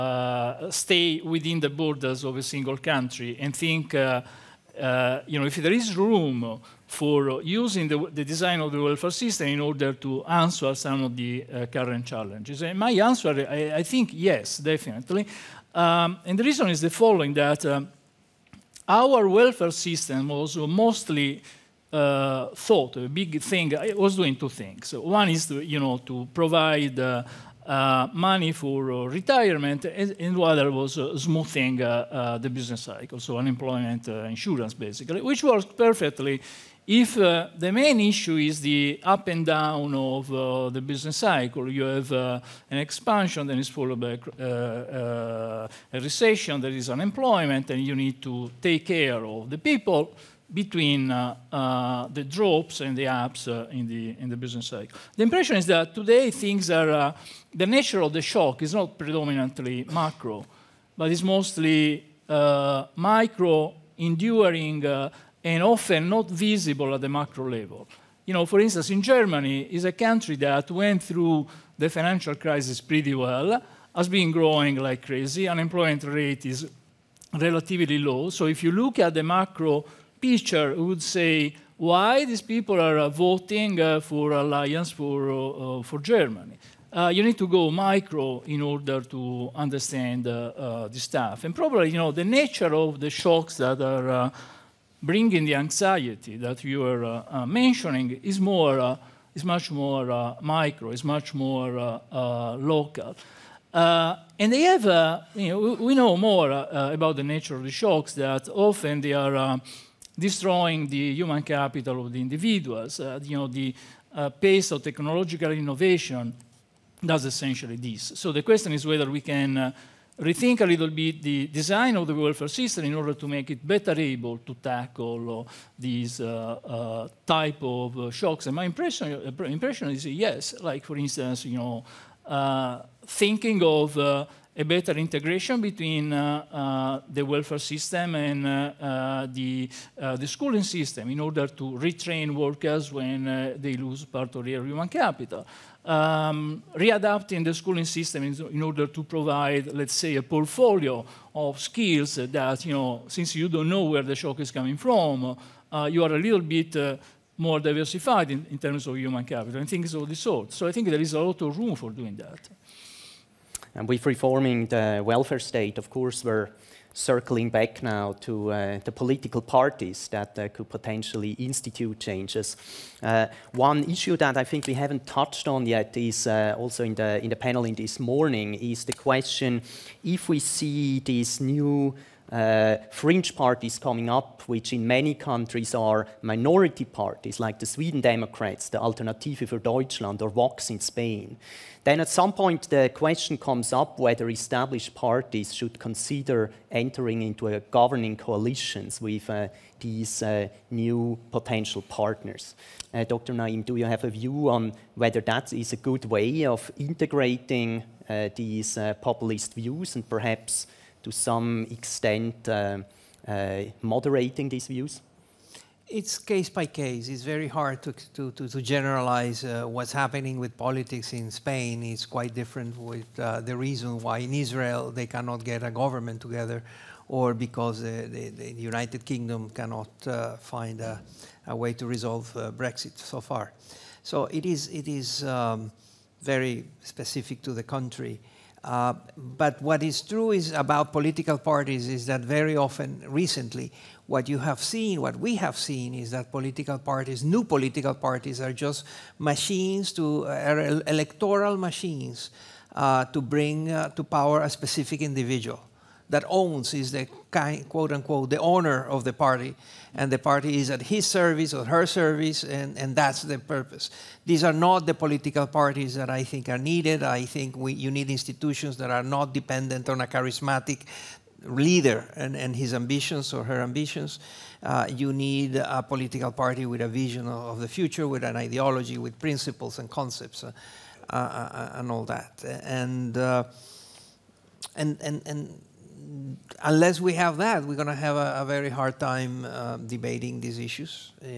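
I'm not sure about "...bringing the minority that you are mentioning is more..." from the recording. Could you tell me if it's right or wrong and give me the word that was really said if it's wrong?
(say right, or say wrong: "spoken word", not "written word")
wrong: "anxiety", not "minority".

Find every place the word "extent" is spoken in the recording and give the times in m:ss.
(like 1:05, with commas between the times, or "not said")
3:31.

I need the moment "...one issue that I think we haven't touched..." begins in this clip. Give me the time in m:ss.
2:53.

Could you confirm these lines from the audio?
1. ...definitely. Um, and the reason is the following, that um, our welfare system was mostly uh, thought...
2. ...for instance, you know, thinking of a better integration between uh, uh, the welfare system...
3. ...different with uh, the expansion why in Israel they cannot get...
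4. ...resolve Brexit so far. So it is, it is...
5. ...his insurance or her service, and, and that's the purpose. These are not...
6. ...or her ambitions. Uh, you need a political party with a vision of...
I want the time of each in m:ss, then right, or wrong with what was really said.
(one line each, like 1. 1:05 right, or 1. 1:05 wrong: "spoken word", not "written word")
1. 0:14 right
2. 2:10 right
3. 3:42 wrong: "reason", not "expansion"
4. 3:51 right
5. 4:20 wrong: "service", not "insurance"
6. 4:33 right.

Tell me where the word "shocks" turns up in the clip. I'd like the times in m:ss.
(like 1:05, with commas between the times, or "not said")
0:58, 1:33, 1:47, 2:08, 2:34.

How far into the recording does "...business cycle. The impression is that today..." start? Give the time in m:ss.
0:54.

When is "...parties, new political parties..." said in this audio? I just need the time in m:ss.
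4:06.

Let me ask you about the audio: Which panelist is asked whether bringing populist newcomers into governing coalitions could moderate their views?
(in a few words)
Dr. Naím.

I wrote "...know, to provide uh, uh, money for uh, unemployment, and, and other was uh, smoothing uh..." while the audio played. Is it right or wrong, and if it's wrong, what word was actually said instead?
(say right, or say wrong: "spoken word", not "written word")
wrong: "retirement", not "unemployment".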